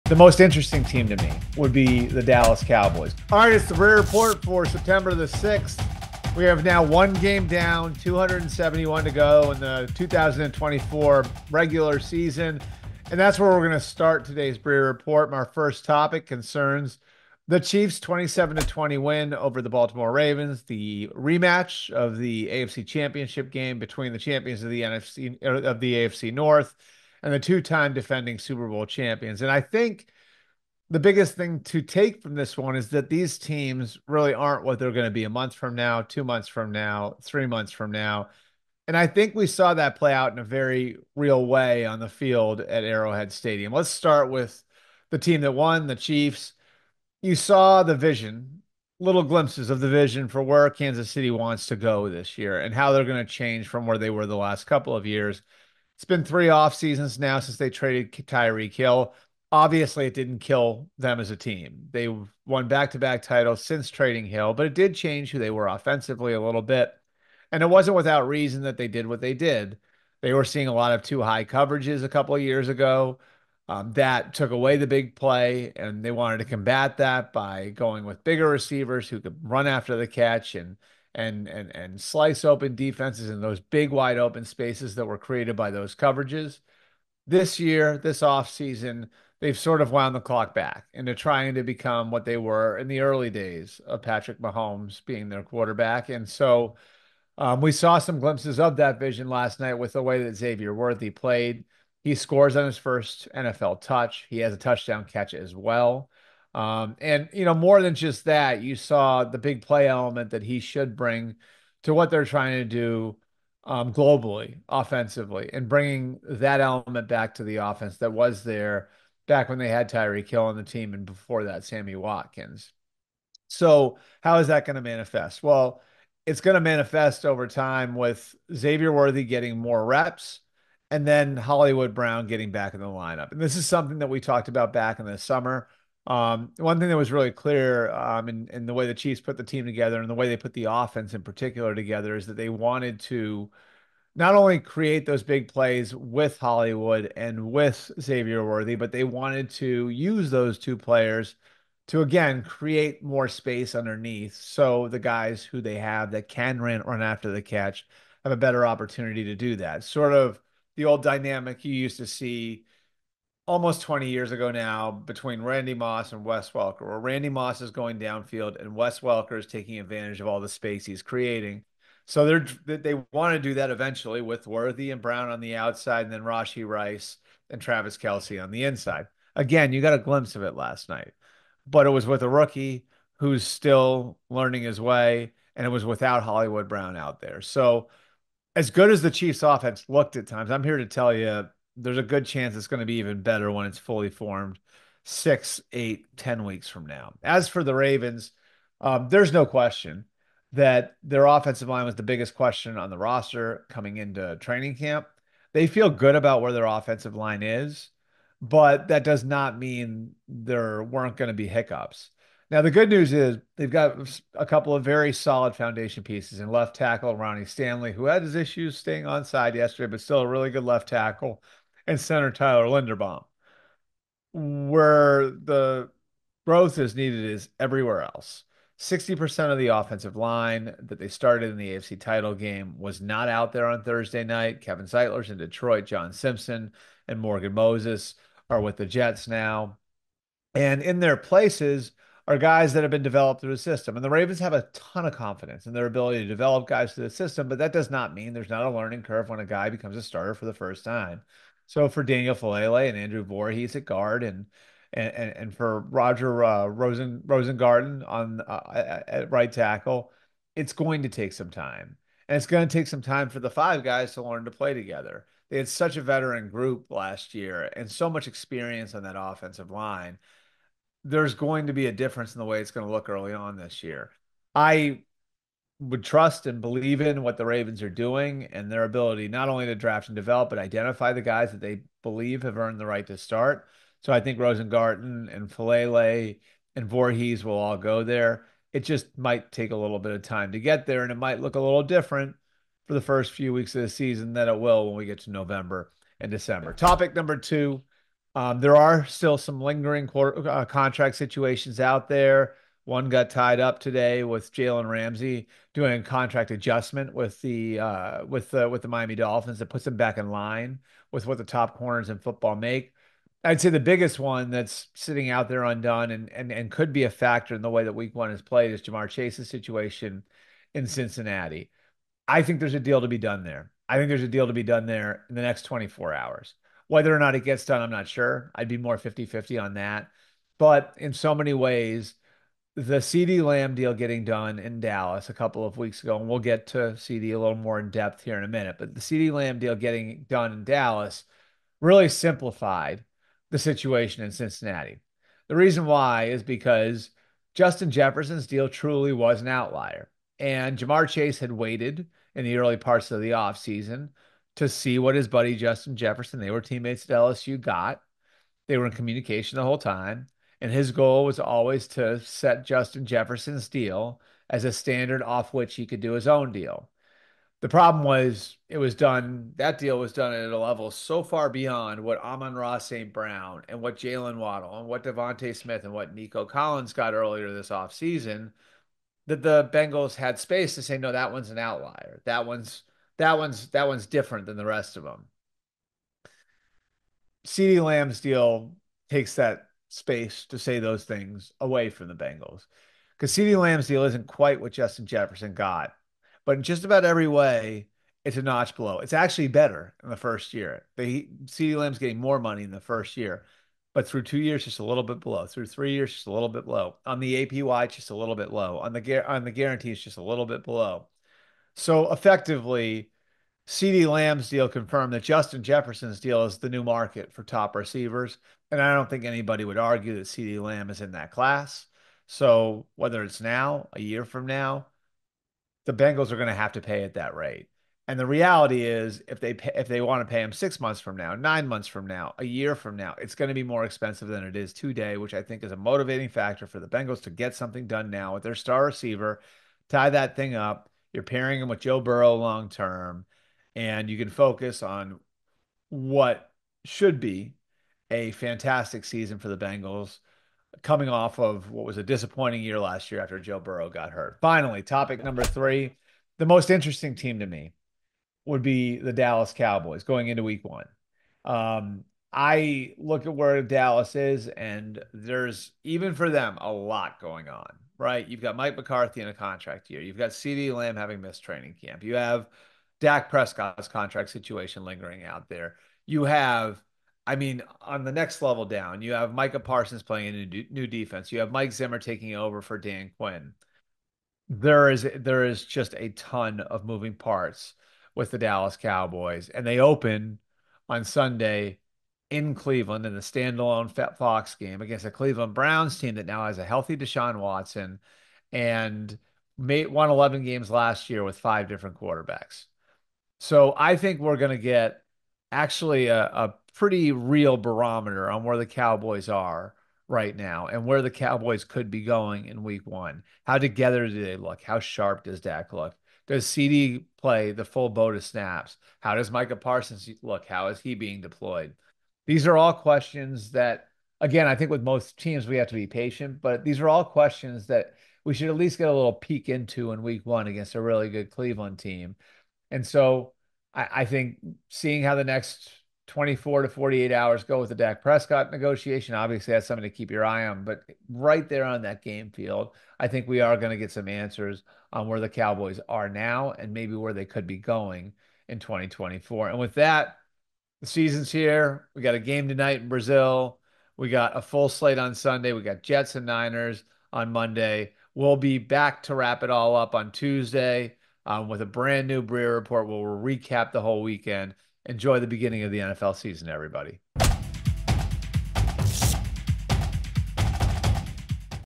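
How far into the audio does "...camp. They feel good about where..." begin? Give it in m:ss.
3:24.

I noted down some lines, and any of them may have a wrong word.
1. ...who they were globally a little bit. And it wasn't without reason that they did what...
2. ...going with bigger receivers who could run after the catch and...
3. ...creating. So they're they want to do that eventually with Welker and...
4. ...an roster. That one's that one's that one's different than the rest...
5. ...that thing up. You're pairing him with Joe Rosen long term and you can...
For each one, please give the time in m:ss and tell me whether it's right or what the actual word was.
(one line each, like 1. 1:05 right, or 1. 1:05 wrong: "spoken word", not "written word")
1. 1:05 wrong: "offensively", not "globally"
2. 1:17 right
3. 2:51 wrong: "Worthy", not "Welker"
4. 6:21 wrong: "outlier", not "roster"
5. 7:20 wrong: "Burrow", not "Rosen".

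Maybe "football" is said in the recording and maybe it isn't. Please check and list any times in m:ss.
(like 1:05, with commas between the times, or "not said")
5:12.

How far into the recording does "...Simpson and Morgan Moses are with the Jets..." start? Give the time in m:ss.
3:56.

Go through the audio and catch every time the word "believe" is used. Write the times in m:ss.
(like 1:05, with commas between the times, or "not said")
4:36, 4:42.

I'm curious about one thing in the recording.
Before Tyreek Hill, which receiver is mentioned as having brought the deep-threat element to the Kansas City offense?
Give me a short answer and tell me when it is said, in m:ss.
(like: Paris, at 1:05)
Sammy Watkins, at 2:01.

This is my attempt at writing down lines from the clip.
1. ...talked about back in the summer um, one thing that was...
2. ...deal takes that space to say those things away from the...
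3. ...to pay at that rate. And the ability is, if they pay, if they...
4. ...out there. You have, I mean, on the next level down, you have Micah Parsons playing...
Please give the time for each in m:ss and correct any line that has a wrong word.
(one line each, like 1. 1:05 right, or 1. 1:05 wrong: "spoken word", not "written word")
1. 2:14 right
2. 6:28 right
3. 7:06 wrong: "reality", not "ability"
4. 7:55 right.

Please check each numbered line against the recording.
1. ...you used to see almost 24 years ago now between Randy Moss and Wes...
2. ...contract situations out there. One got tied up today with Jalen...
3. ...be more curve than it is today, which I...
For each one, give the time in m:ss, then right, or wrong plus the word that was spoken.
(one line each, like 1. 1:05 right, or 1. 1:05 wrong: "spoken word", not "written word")
1. 2:41 wrong: "20", not "24"
2. 5:00 right
3. 7:13 wrong: "expensive", not "curve".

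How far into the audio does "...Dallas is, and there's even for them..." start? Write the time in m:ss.
7:43.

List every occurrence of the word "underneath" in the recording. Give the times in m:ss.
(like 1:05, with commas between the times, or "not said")
2:33.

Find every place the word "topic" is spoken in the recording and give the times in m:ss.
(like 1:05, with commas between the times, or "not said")
0:15, 4:56, 7:34.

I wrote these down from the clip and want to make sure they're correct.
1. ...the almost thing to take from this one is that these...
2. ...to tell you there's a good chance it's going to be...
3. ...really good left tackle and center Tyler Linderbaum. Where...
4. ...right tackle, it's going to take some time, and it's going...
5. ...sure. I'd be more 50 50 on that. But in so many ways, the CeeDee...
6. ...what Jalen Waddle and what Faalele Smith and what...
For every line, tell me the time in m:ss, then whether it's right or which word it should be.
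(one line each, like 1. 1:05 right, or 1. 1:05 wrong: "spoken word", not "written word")
1. 0:30 wrong: "biggest", not "almost"
2. 3:10 right
3. 3:40 right
4. 4:19 right
5. 5:28 right
6. 6:13 wrong: "DeVonta", not "Faalele".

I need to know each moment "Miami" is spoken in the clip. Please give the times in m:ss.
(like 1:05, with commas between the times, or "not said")
5:08.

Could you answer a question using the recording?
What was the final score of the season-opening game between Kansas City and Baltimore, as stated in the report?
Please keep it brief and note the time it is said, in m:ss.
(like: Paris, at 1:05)
27-20, at 0:18.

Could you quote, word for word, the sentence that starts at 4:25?
They had such a veteran group last year and so much experience on that offensive line.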